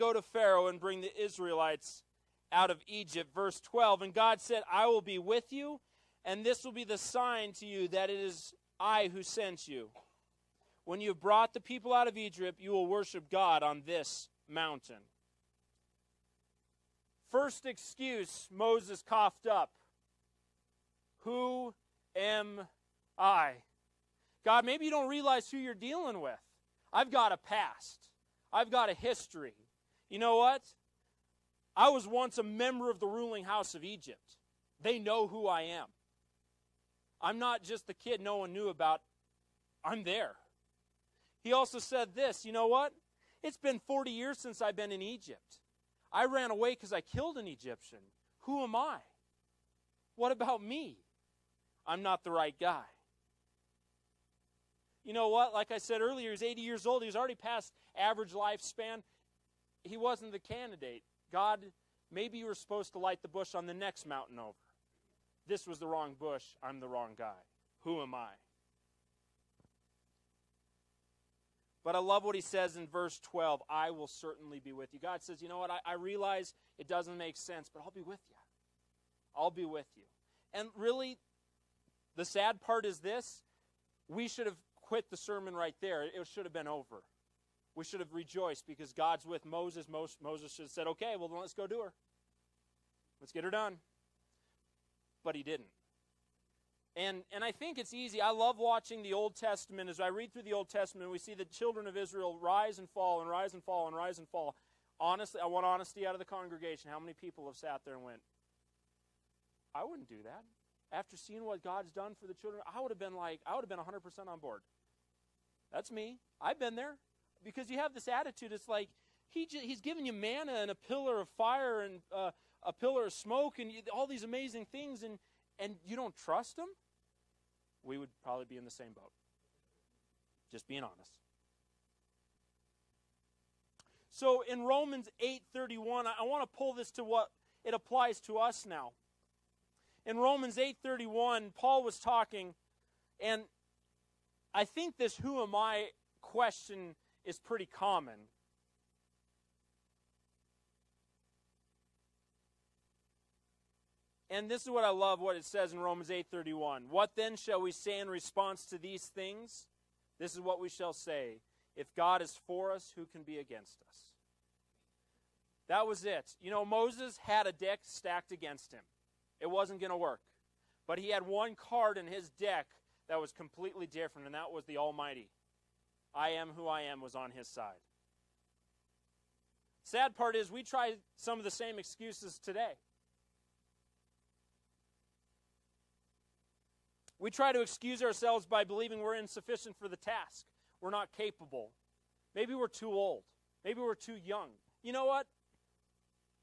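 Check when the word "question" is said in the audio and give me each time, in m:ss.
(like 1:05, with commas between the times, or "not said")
2:26.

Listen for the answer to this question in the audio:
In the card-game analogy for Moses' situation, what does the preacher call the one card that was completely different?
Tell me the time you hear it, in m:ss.
2:54.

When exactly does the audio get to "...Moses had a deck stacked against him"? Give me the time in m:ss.
2:46.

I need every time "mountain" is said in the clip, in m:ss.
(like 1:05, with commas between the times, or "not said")
0:14, 1:04.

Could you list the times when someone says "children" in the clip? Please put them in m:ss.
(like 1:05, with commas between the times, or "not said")
1:41, 1:52.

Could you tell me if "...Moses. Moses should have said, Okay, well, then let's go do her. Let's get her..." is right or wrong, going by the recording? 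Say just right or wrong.
right.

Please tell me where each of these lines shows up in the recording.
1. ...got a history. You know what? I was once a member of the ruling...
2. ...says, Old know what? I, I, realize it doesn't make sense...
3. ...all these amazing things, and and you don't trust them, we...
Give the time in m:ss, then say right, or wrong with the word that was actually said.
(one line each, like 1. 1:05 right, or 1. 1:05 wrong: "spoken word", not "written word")
1. 0:28 right
2. 1:15 wrong: "You", not "Old"
3. 2:03 right.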